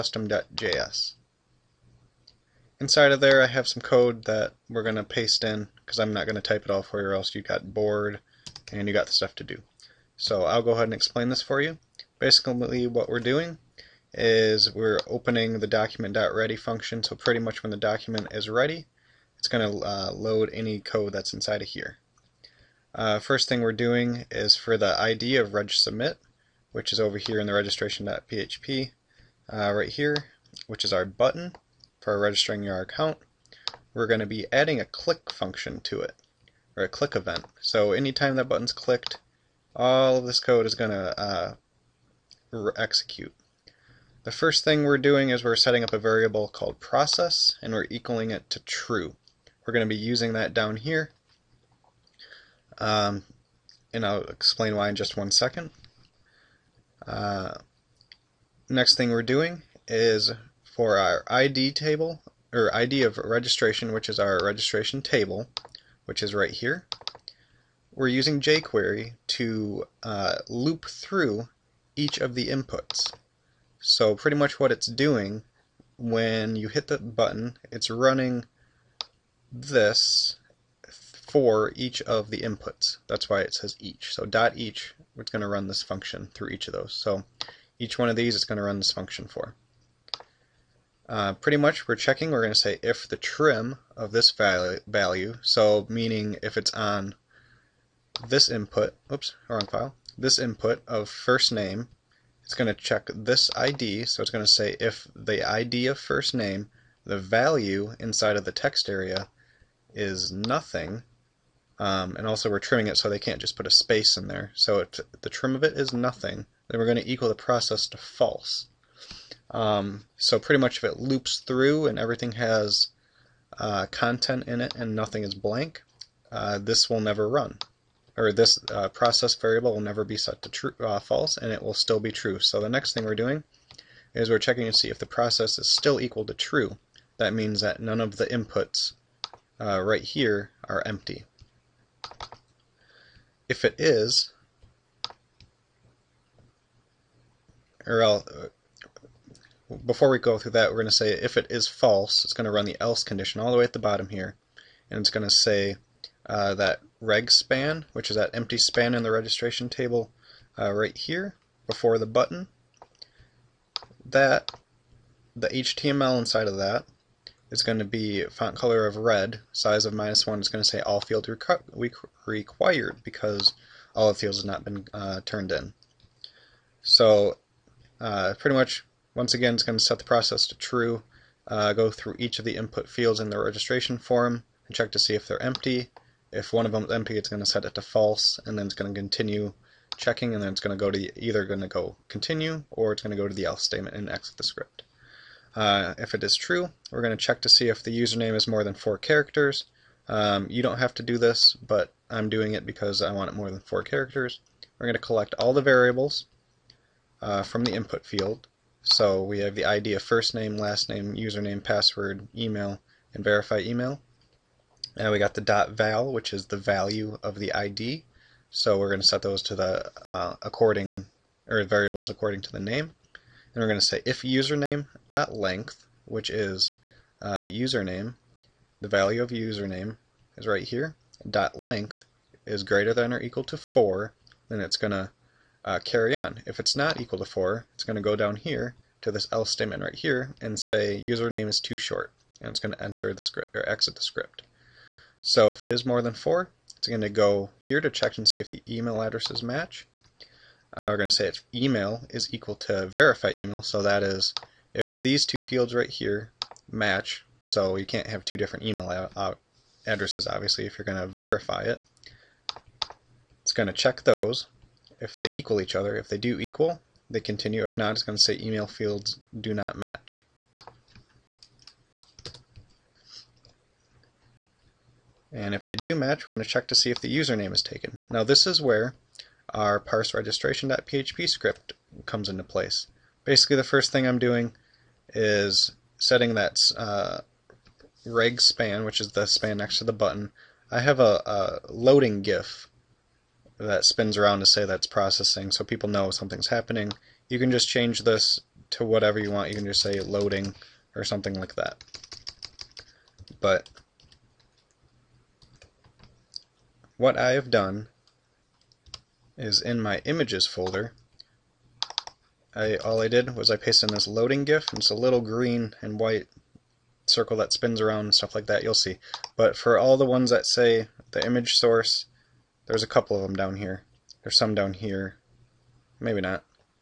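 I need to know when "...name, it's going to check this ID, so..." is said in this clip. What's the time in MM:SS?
01:41.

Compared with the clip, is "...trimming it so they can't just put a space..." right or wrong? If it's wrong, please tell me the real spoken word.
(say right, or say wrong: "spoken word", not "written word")
right.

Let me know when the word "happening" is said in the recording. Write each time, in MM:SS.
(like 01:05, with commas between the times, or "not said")
04:56.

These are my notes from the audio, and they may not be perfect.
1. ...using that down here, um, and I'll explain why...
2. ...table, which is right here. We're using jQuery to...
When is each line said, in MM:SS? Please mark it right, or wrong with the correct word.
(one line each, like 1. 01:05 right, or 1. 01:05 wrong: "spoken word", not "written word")
1. 00:49 right
2. 01:05 right.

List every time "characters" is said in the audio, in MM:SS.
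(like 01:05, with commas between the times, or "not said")
03:18, 03:23.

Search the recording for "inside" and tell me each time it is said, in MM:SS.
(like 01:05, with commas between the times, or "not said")
00:02, 00:21, 01:47, 02:46.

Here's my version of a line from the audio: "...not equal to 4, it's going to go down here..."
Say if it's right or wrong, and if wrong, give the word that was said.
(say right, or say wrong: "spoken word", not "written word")
right.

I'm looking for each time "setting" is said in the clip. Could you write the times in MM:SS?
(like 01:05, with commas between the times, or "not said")
00:45, 04:45.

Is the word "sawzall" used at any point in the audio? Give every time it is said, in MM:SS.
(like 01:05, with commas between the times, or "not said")
not said.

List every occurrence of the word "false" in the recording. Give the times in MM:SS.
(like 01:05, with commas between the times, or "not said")
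01:57, 02:10, 02:31, 03:07.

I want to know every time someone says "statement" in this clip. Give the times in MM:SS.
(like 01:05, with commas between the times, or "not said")
03:13, 03:59.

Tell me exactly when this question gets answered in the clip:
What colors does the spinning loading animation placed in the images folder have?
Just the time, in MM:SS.
05:15.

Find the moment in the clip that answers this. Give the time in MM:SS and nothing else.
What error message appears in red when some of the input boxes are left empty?
02:50.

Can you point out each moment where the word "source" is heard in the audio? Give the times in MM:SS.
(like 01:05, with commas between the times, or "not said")
05:21.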